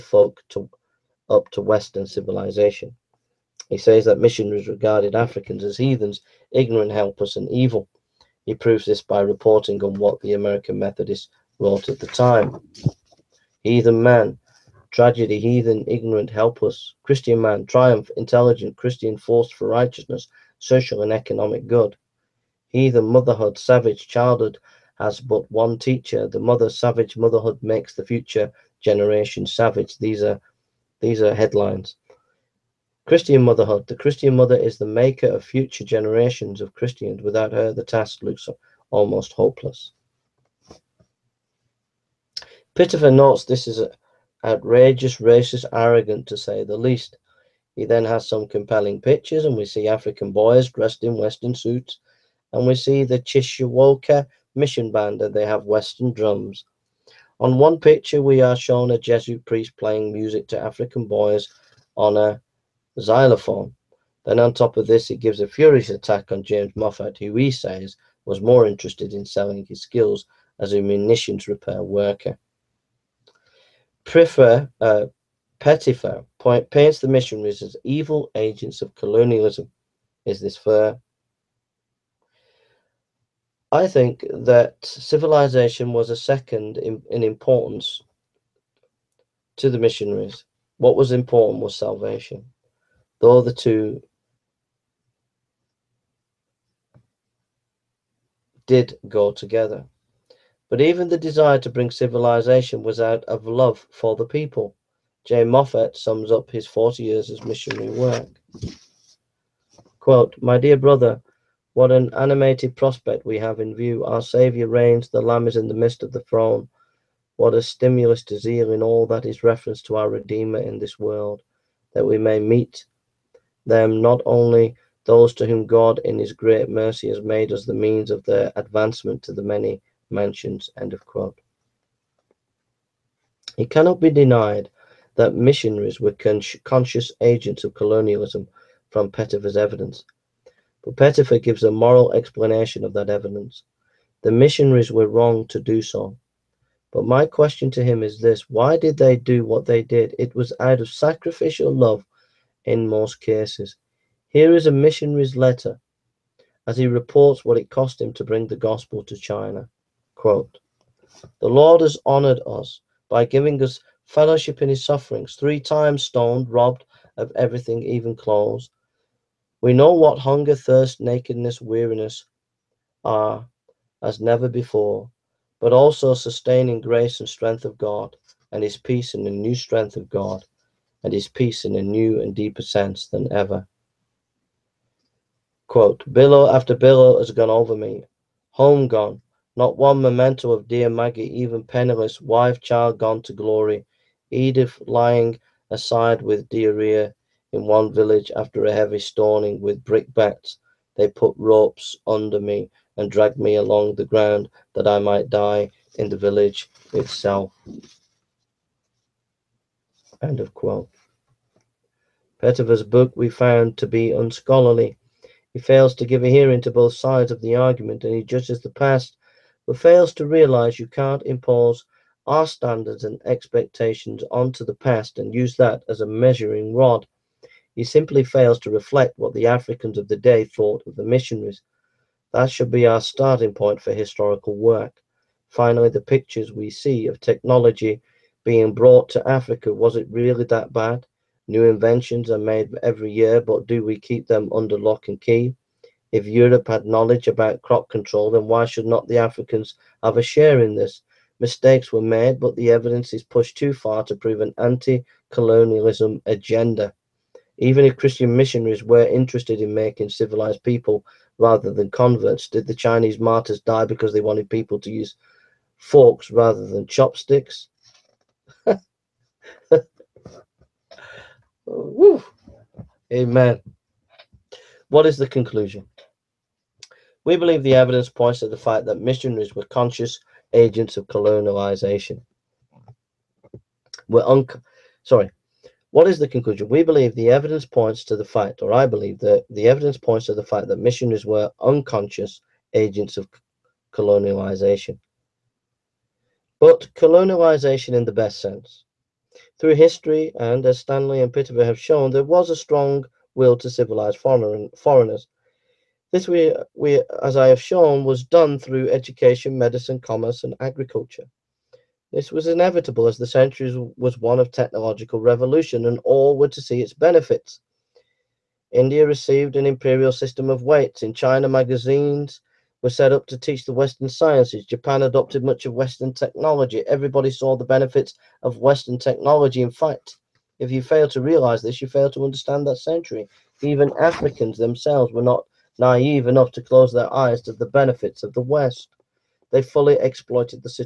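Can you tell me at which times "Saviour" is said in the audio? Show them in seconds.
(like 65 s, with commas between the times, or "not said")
114 s.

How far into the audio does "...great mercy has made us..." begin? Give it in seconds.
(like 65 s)
126 s.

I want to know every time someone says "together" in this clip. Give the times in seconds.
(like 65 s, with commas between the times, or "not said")
99 s.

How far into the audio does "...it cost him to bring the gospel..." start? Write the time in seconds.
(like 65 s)
157 s.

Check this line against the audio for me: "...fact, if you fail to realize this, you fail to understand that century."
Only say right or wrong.
right.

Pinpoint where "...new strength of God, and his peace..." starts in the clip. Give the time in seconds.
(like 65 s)
179 s.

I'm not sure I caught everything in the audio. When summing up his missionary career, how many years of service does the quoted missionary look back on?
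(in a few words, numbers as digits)
40.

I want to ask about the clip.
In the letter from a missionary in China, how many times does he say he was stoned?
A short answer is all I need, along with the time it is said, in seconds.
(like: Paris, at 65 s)
3, at 165 s.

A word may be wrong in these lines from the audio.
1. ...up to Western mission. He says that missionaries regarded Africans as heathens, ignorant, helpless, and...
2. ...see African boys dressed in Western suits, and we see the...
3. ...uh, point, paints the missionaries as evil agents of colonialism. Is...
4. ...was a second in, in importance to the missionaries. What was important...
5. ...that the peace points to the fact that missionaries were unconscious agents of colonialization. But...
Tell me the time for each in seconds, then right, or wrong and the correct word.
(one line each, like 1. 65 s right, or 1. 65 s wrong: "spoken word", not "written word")
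1. 1 s wrong: "civilization", not "mission"
2. 49 s right
3. 74 s right
4. 85 s right
5. 289 s wrong: "evidence", not "peace".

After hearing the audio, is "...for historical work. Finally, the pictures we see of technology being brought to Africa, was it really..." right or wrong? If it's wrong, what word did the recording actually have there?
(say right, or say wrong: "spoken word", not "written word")
right.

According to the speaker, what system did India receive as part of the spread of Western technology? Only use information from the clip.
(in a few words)
Imperial system of weights.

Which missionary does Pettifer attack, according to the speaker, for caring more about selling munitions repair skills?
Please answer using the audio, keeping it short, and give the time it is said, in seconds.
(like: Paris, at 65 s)
James Moffat, at 66 s.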